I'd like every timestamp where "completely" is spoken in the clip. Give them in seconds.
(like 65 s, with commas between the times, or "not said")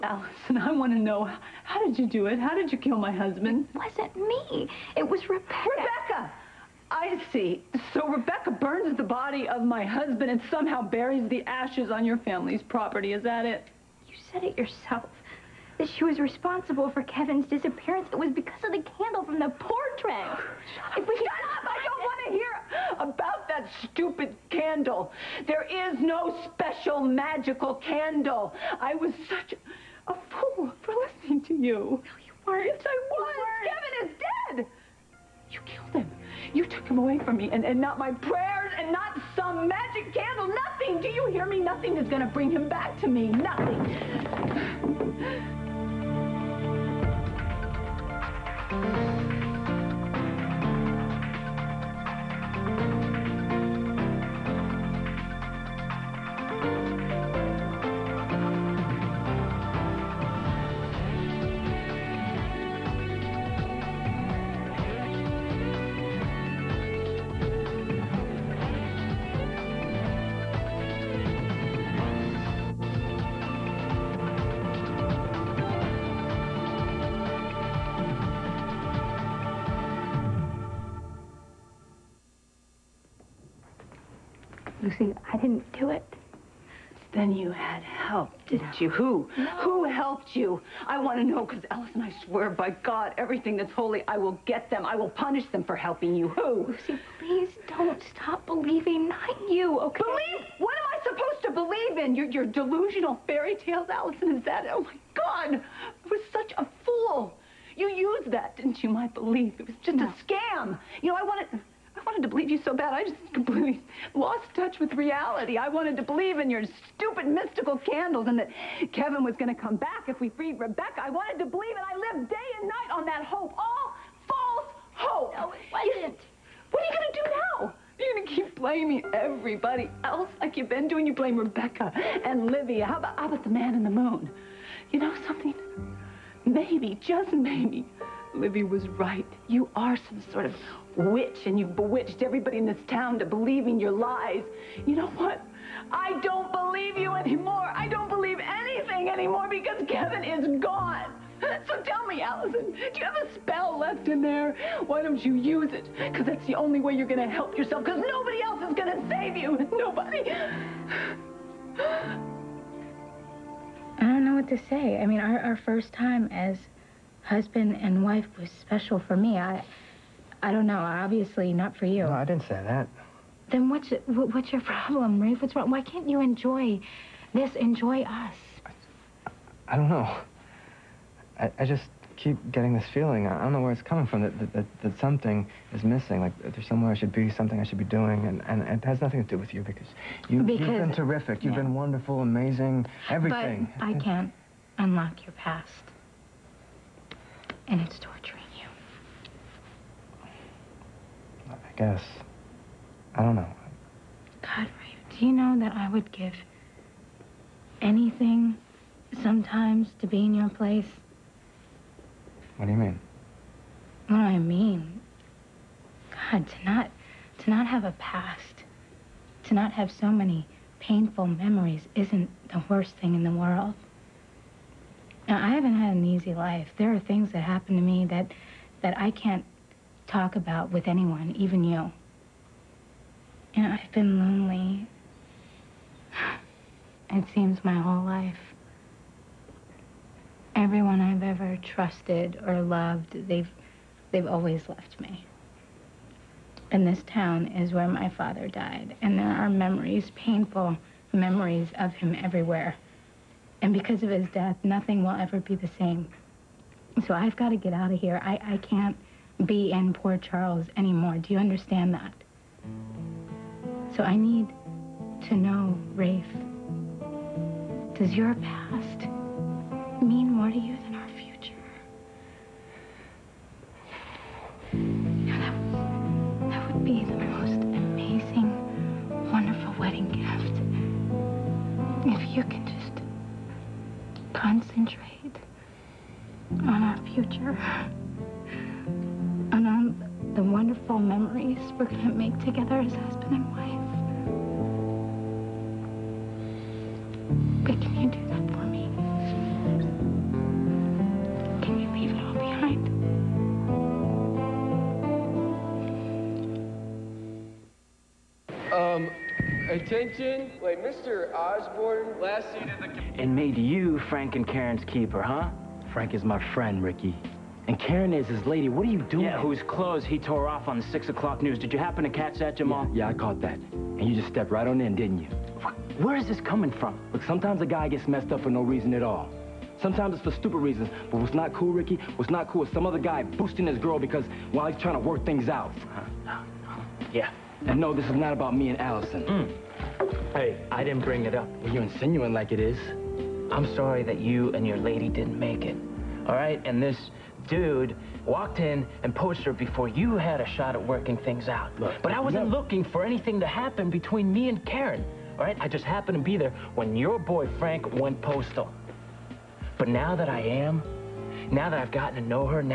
113 s.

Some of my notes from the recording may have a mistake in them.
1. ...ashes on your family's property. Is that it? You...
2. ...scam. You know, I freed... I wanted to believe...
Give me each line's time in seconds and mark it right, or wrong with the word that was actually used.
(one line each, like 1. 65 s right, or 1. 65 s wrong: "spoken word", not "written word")
1. 11 s right
2. 110 s wrong: "wanted", not "freed".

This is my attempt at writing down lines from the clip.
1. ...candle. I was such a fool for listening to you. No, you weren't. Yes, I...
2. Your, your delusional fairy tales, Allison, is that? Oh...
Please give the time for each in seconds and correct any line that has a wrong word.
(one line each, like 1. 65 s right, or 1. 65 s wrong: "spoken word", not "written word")
1. 27 s right
2. 102 s right.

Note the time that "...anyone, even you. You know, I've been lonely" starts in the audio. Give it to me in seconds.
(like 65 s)
230 s.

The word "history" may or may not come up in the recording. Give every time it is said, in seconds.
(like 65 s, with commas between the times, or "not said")
not said.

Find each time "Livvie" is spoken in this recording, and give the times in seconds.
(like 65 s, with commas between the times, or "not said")
132 s, 138 s.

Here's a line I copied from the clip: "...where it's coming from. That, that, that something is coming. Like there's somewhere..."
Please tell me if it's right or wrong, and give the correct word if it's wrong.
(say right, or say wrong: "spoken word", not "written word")
wrong: "missing", not "coming".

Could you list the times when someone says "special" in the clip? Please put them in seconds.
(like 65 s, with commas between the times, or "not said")
26 s, 168 s.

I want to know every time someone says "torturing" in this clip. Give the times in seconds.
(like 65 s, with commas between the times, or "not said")
198 s.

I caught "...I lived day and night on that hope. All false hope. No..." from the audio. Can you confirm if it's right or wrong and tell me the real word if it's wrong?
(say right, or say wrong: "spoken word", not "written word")
right.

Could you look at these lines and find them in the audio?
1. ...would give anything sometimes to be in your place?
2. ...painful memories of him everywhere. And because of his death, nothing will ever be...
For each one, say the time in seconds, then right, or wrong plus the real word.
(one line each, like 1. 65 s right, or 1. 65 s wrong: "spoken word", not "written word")
1. 205 s right
2. 250 s right.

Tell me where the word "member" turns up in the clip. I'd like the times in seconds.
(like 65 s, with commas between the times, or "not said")
not said.